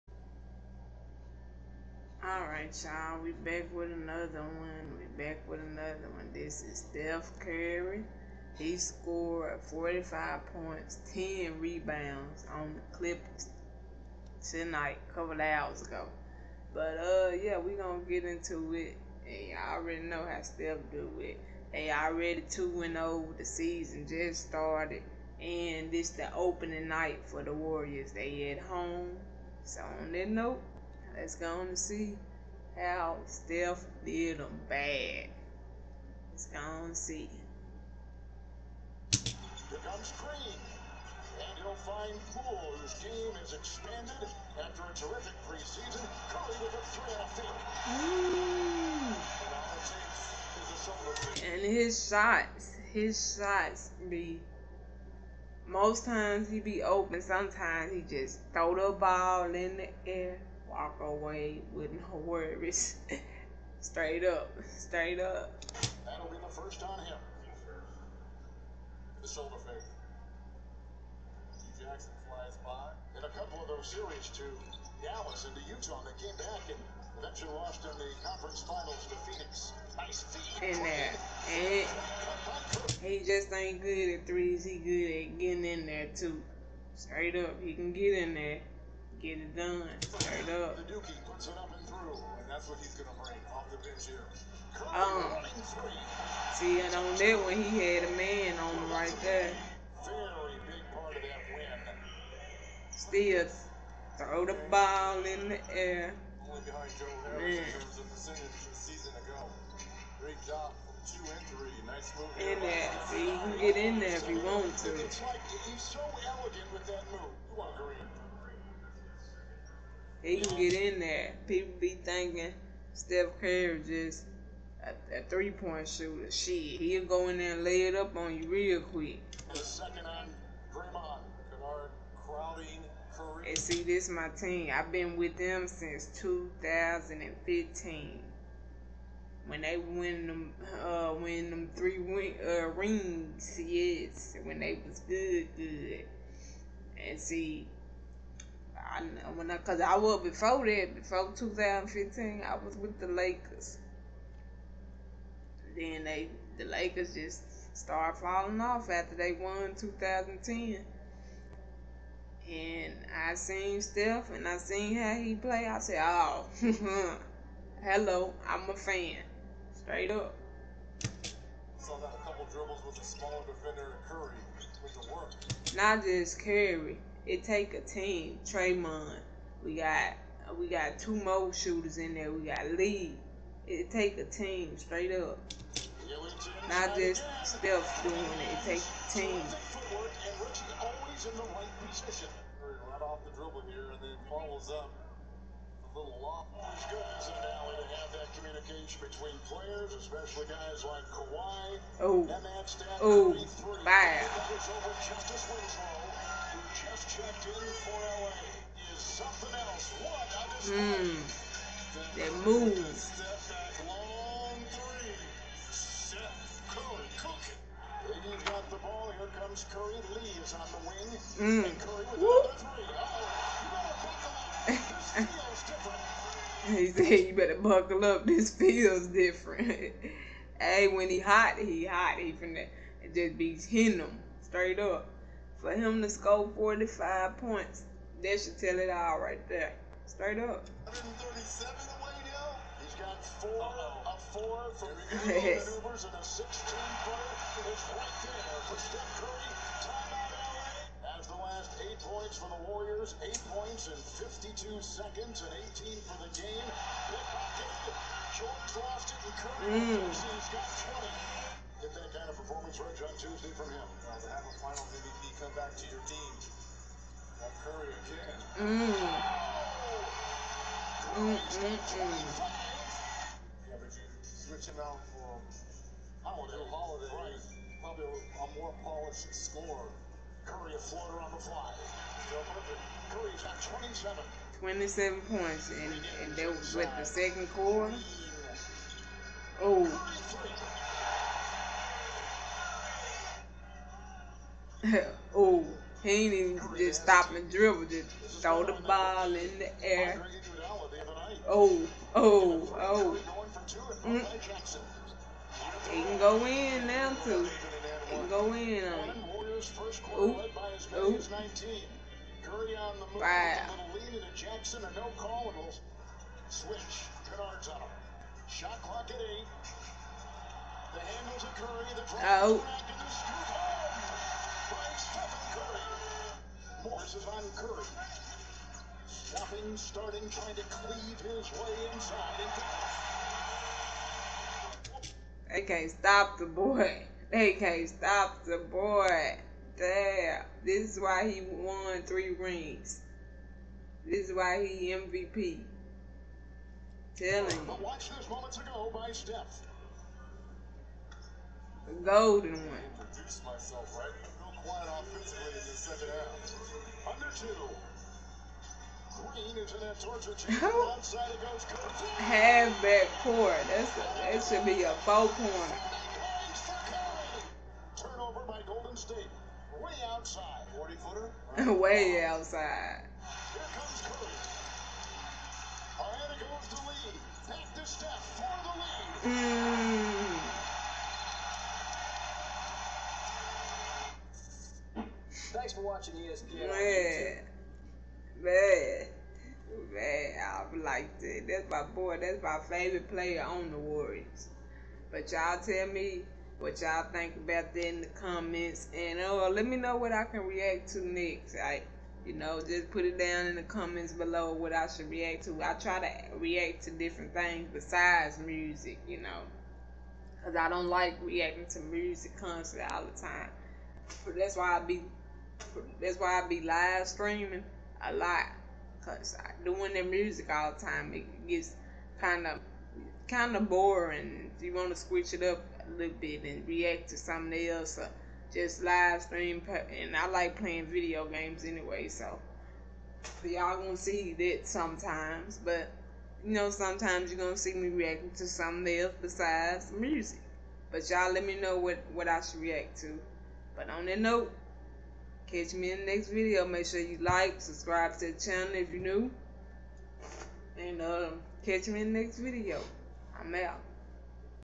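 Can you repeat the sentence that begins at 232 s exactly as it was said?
He finna just be hitting them straight up.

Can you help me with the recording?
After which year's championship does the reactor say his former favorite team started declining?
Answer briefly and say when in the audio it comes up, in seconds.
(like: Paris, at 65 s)
2010, at 159 s.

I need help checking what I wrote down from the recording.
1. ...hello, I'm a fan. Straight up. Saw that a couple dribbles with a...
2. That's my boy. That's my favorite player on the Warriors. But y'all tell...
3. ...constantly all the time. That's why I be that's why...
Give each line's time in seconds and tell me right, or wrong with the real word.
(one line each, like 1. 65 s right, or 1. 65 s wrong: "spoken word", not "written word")
1. 167 s right
2. 391 s right
3. 412 s right.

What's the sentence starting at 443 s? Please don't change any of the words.
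But on that note, Catch me in the next video.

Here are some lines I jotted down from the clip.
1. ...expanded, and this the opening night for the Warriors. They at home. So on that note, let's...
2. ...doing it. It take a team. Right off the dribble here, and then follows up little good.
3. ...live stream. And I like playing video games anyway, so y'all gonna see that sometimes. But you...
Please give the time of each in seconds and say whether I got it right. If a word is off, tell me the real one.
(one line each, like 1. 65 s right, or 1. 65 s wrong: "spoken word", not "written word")
1. 24 s wrong: "started", not "expanded"
2. 188 s right
3. 428 s right.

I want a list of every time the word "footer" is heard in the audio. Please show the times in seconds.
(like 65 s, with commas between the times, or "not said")
247 s, 371 s.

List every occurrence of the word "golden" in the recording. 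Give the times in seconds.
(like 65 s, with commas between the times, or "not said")
352 s, 368 s.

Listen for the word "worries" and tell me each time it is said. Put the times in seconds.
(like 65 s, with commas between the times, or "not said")
62 s.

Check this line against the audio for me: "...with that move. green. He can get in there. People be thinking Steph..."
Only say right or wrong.
right.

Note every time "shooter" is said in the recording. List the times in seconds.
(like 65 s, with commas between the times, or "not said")
125 s, 181 s.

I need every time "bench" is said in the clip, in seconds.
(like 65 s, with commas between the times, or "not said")
93 s.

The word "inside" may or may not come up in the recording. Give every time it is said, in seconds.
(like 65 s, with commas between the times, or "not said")
331 s.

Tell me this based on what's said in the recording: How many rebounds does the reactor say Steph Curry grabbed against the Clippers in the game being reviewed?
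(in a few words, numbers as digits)
10.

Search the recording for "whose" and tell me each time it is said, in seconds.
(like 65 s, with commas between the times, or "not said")
42 s.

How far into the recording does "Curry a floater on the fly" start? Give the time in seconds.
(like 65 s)
280 s.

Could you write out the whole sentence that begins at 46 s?
Curry with a three and a fake.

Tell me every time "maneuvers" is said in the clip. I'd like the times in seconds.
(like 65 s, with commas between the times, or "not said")
245 s.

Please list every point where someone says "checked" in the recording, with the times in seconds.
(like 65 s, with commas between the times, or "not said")
207 s.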